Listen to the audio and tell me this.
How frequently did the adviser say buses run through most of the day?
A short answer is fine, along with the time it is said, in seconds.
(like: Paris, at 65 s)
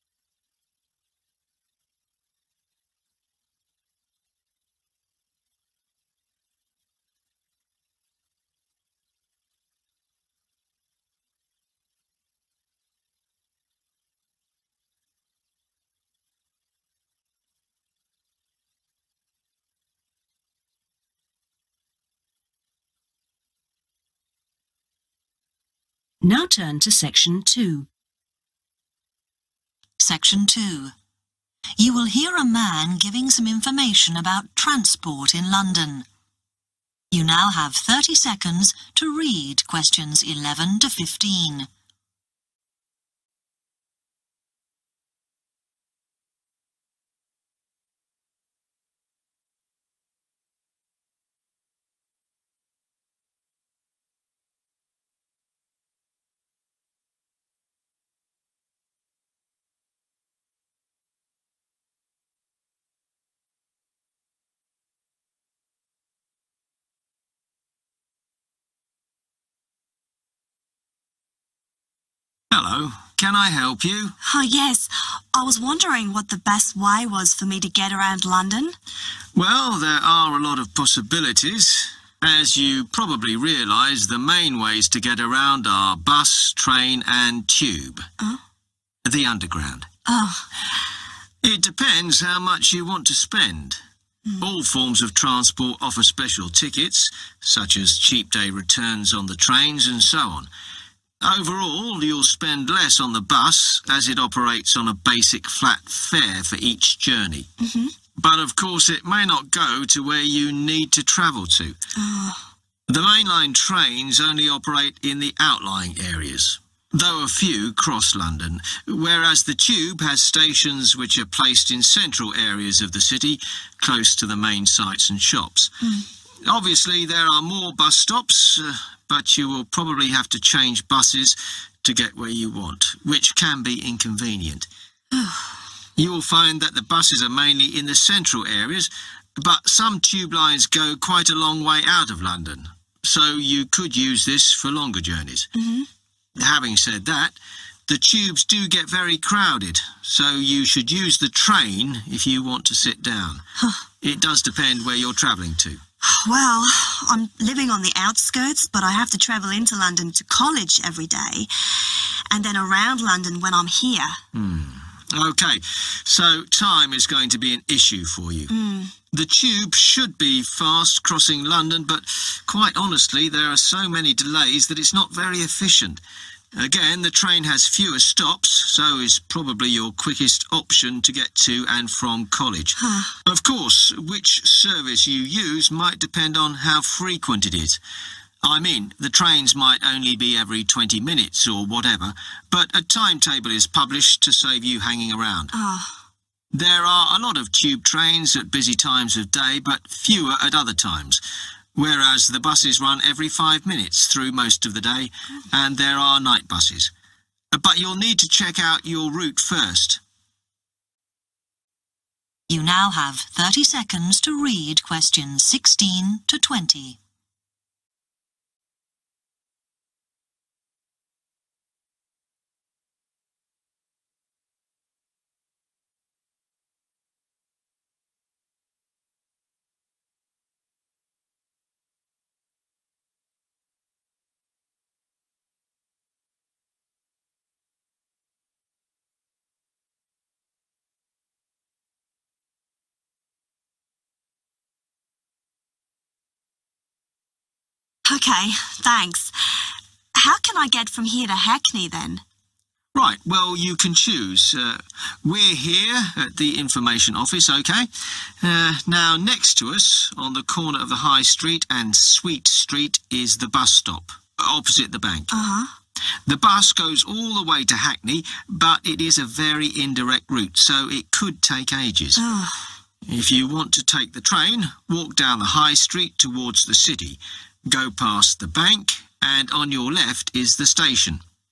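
every 5 minutes, at 203 s.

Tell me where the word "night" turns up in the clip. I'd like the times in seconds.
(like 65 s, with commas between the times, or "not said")
206 s.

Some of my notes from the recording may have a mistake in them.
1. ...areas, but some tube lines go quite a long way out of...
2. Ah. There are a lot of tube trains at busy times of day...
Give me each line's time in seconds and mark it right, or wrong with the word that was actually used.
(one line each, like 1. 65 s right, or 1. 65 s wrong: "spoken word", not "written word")
1. 138 s right
2. 195 s right.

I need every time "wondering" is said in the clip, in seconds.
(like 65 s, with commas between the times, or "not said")
75 s.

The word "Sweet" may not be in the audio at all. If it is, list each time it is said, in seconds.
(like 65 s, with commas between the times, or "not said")
261 s.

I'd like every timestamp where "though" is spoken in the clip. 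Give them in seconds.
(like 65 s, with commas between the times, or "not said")
116 s.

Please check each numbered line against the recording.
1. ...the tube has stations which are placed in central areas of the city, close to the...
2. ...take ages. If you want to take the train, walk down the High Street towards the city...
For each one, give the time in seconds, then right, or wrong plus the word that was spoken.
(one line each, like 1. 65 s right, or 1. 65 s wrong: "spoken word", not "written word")
1. 119 s right
2. 271 s right.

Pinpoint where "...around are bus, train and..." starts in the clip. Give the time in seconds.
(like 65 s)
85 s.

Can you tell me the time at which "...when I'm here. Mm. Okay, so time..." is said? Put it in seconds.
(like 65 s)
163 s.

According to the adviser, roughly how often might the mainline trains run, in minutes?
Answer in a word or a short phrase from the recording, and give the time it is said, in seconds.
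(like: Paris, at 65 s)
20, at 190 s.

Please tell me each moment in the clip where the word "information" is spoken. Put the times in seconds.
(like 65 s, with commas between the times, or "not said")
33 s, 256 s.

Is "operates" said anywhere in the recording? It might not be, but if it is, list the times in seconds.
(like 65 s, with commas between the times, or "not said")
104 s, 114 s.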